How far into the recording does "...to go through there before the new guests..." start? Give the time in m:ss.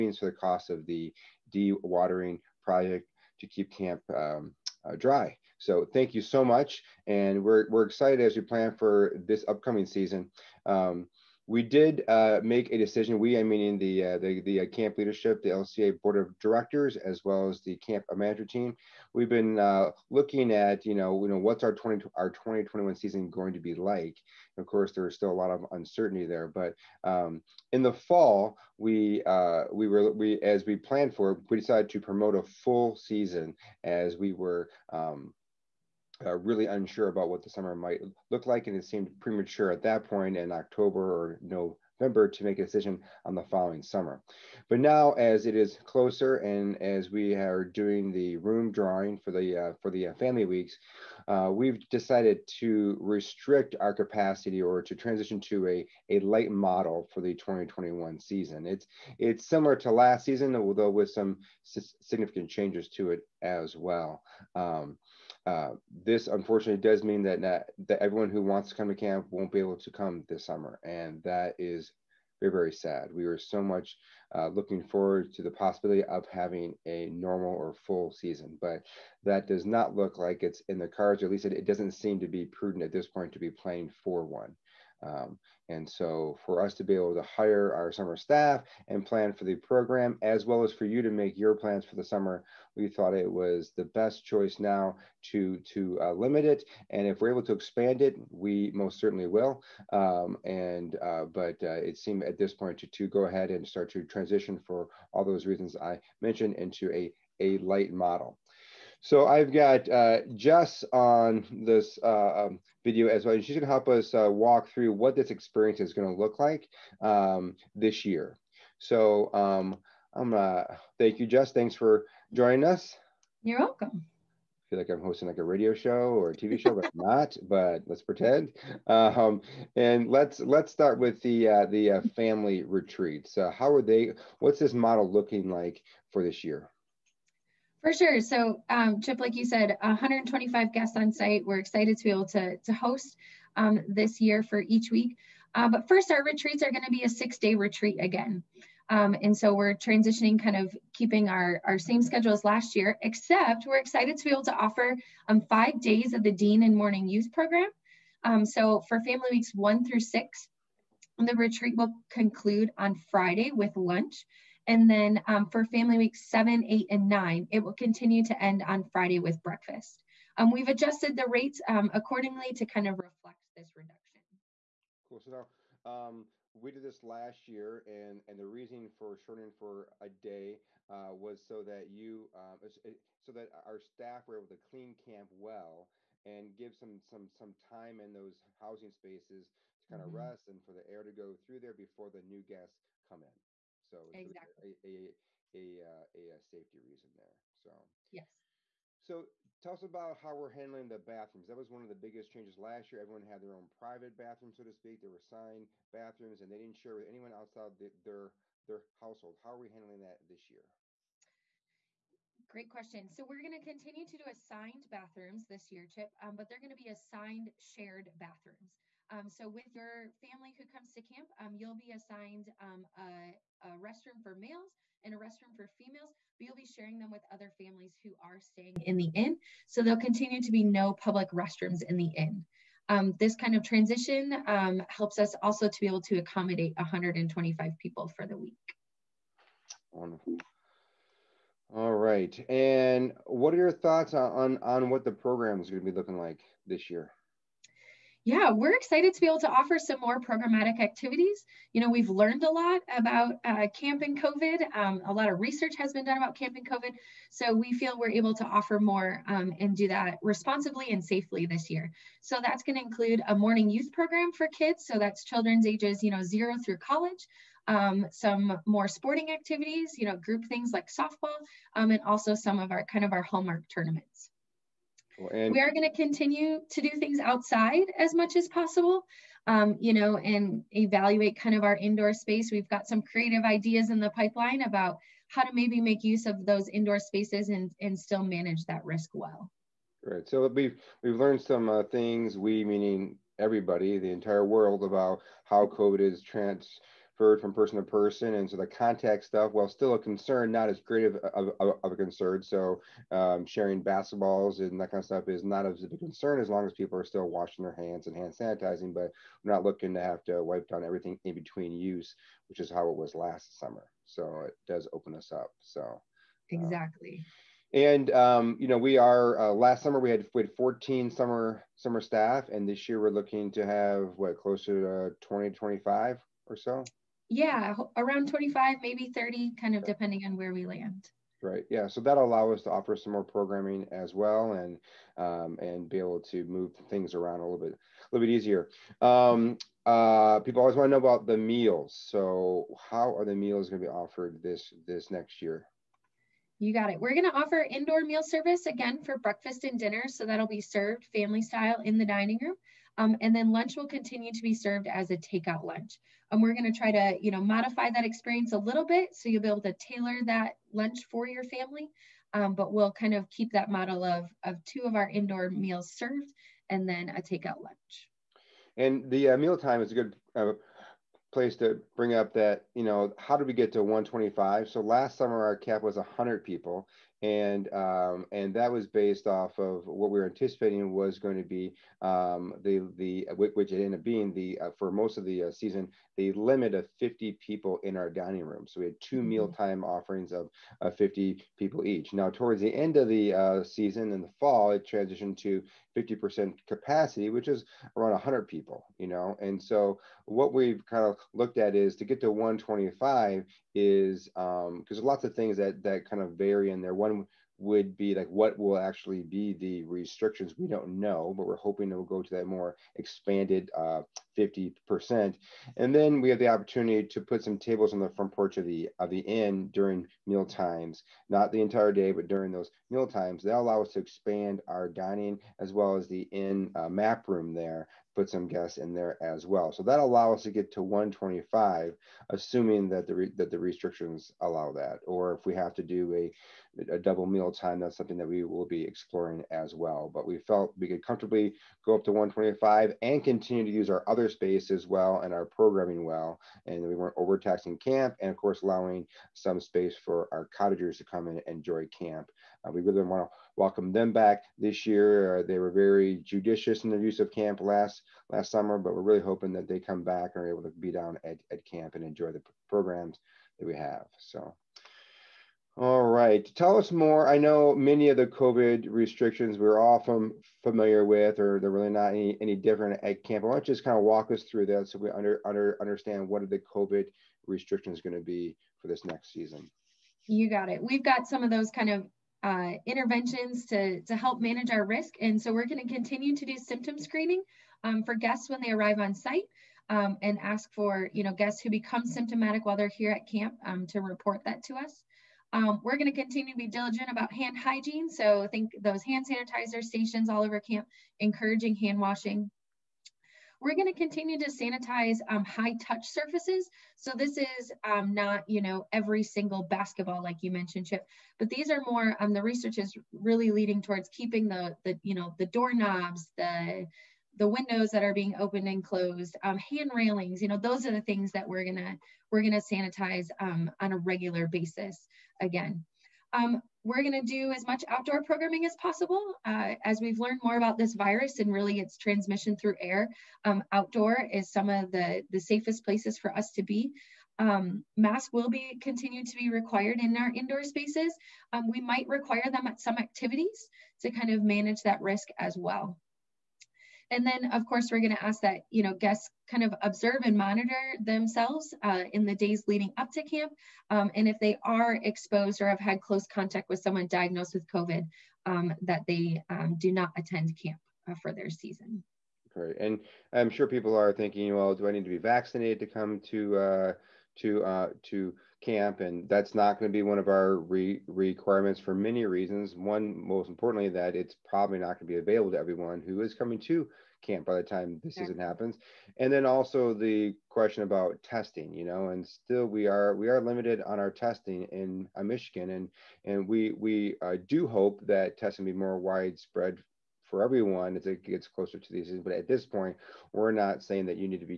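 3:11.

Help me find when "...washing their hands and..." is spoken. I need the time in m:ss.
5:07.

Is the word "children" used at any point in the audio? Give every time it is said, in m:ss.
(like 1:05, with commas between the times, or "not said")
4:25.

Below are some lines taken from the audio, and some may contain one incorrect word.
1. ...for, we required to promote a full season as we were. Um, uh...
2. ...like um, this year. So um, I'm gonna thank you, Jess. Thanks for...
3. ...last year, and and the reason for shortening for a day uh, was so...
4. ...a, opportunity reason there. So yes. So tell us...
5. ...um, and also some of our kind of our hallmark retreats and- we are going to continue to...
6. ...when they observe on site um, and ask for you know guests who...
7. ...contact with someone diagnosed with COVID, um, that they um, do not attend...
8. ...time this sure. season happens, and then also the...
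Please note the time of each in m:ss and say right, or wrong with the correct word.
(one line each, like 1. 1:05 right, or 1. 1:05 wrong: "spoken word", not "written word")
1. 0:31 wrong: "decided", not "required"
2. 1:56 right
3. 2:57 right
4. 3:16 wrong: "safety", not "opportunity"
5. 4:31 wrong: "tournaments", not "retreats"
6. 8:08 wrong: "arrive", not "observe"
7. 9:16 right
8. 9:37 right.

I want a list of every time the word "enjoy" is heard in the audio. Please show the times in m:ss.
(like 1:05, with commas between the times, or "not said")
7:31, 7:42.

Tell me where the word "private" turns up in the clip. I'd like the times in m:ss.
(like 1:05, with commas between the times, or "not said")
3:23.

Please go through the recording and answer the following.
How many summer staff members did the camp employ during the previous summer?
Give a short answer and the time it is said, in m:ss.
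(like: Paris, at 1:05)
14, at 5:20.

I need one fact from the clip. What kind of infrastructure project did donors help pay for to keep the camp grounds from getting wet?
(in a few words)
dewatering project.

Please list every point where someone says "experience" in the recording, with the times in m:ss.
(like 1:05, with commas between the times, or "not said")
1:55, 5:58.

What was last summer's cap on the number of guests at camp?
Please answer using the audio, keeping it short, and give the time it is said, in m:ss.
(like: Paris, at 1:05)
100 people, at 6:15.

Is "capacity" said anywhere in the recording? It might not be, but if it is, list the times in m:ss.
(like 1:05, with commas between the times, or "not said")
0:53, 6:36.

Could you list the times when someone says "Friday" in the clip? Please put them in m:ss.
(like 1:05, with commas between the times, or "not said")
2:43, 2:48.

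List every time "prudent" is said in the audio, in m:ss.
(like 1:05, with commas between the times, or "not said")
1:22.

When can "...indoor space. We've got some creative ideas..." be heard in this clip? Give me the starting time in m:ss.
4:41.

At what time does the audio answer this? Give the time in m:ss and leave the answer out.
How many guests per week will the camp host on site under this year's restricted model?
2:19.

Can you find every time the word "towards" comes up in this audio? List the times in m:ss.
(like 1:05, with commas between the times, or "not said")
6:32, 8:33.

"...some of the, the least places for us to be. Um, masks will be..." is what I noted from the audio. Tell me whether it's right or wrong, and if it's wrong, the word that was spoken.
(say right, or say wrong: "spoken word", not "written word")
wrong: "safest", not "least".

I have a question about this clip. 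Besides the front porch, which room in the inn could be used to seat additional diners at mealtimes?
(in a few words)
map room.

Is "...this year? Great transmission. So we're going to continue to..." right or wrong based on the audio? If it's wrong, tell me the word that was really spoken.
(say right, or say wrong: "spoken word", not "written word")
wrong: "question", not "transmission".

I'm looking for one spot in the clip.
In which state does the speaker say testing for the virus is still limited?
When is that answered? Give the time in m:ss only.
9:45.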